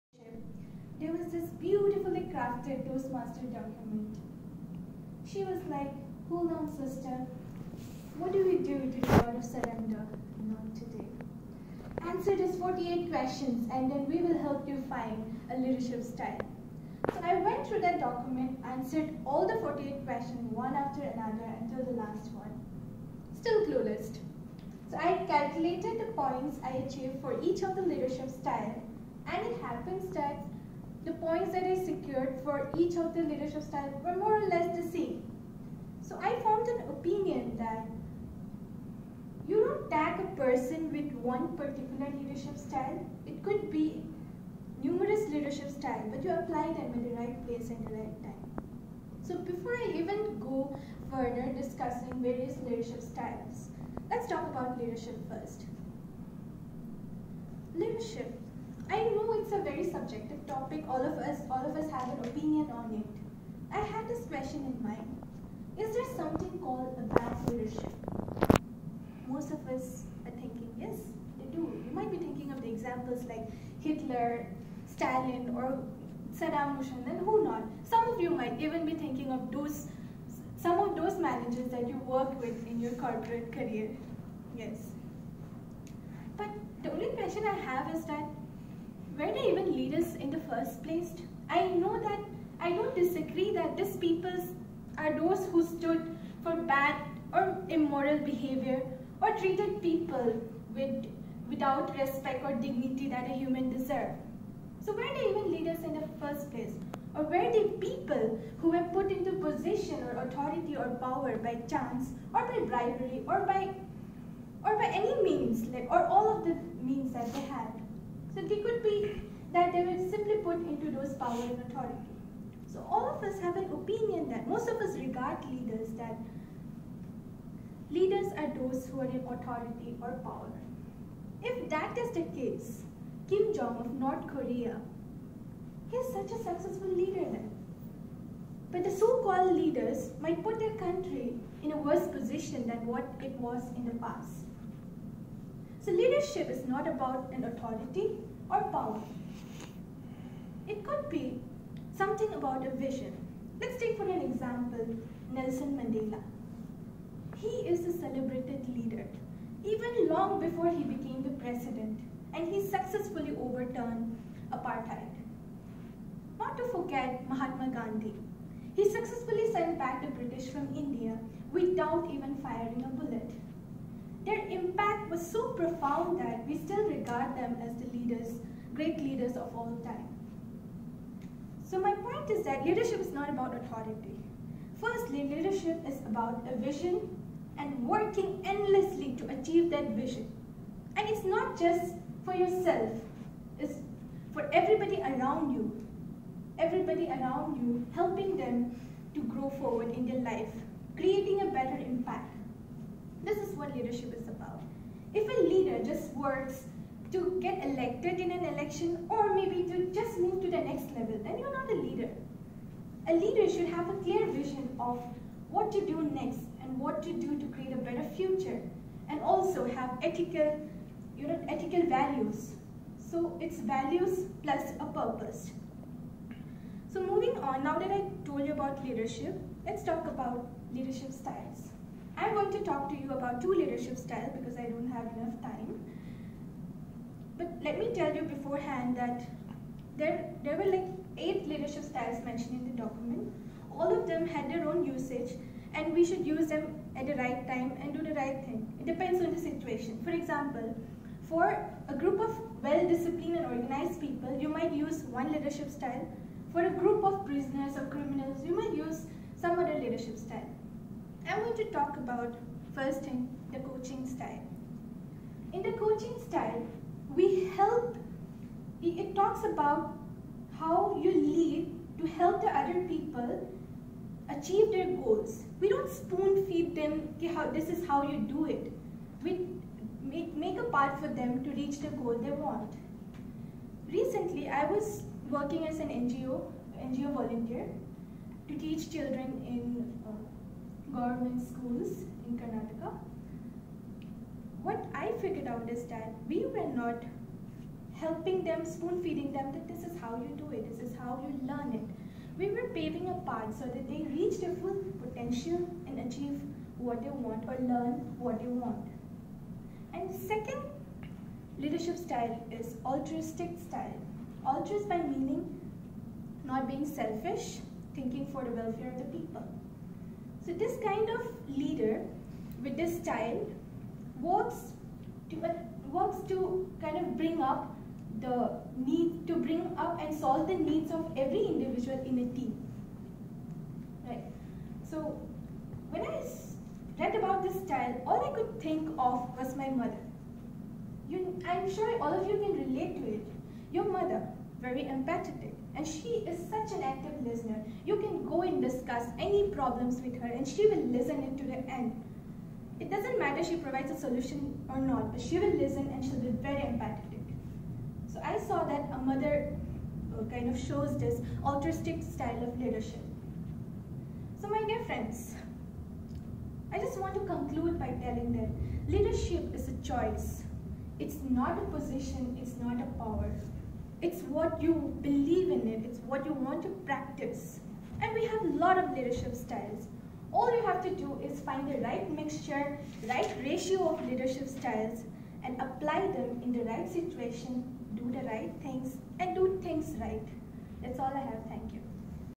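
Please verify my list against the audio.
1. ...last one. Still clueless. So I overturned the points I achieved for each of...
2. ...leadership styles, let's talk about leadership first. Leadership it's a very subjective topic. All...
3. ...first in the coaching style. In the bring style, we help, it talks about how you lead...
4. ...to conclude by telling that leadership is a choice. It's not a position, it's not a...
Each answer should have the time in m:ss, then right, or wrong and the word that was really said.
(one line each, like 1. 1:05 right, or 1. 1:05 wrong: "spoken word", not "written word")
1. 0:21 wrong: "calculated", not "overturned"
2. 0:52 right
3. 4:22 wrong: "coaching", not "bring"
4. 6:07 right.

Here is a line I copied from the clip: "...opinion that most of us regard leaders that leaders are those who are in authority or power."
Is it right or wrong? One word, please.
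right.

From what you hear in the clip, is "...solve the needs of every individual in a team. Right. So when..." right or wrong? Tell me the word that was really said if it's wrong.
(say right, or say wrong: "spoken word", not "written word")
right.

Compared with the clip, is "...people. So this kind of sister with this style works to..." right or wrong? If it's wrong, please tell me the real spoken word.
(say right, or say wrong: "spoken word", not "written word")
wrong: "leader", not "sister".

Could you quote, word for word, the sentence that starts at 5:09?
And second leadership style is altruistic style.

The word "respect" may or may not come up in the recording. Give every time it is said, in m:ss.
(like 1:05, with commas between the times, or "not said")
1:41.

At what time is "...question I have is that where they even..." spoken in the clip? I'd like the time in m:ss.
1:27.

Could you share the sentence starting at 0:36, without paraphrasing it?
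So I formed an opinion that you don't tag a person with one particular leadership style.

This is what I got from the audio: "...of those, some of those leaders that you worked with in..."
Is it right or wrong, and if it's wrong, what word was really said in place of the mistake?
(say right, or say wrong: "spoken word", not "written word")
wrong: "managers", not "leaders".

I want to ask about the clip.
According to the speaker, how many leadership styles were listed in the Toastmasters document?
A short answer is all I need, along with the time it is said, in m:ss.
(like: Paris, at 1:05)
8, at 4:01.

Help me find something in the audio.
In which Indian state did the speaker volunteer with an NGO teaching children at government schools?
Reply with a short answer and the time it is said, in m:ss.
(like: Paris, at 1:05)
Karnataka, at 4:52.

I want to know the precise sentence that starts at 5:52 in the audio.
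It doesn't matter she provides a solution or not, but she will listen and she'll be very empathetic.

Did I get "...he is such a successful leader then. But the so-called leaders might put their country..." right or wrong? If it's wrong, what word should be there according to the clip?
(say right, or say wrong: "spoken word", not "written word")
right.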